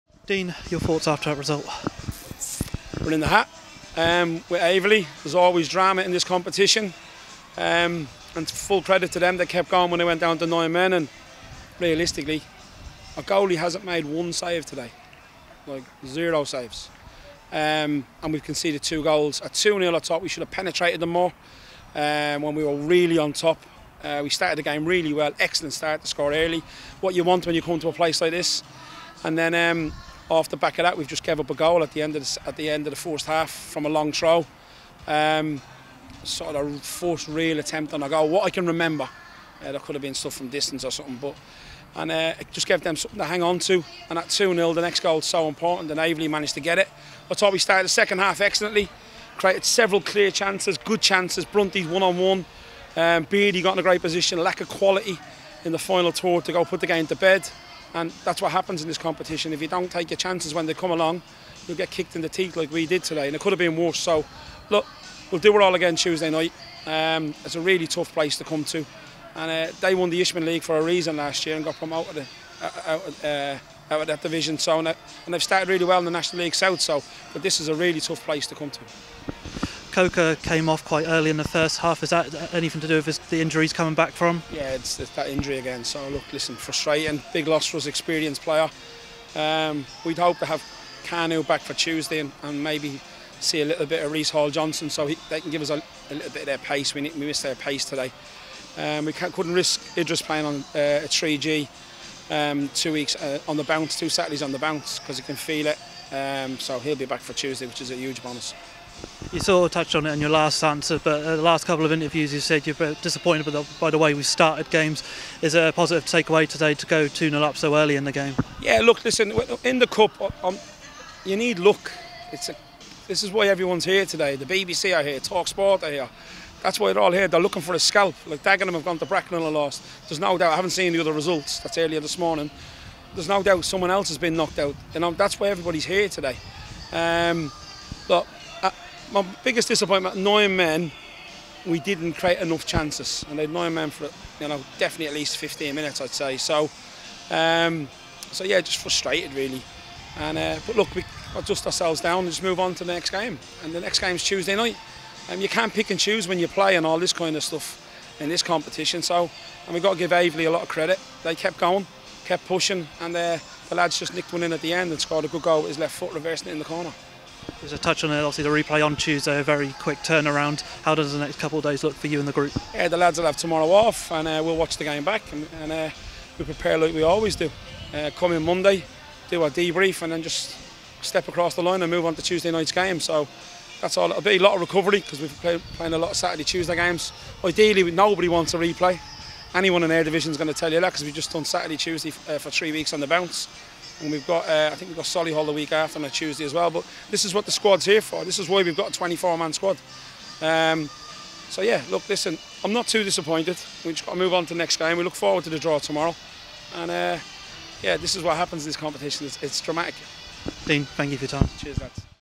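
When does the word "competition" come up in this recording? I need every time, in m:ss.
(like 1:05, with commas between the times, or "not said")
0:06, 0:58, 2:38, 3:28.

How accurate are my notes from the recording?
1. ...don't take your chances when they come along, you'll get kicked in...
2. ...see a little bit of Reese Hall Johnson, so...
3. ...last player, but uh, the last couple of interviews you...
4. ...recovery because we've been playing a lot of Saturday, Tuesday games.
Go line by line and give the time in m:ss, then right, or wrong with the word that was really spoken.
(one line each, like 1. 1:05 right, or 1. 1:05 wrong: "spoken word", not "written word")
1. 0:59 right
2. 1:33 right
3. 1:50 wrong: "answer", not "player"
4. 3:04 right.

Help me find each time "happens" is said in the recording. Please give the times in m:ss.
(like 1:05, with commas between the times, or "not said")
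0:58, 3:28.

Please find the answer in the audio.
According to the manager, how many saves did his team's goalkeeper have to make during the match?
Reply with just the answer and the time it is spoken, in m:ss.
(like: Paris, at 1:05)
0, at 0:16.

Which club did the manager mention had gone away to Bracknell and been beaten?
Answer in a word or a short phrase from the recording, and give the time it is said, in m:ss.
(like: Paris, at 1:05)
Dagenham, at 2:08.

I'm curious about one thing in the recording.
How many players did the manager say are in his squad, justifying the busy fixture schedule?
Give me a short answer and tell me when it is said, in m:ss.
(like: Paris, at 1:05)
24, at 3:18.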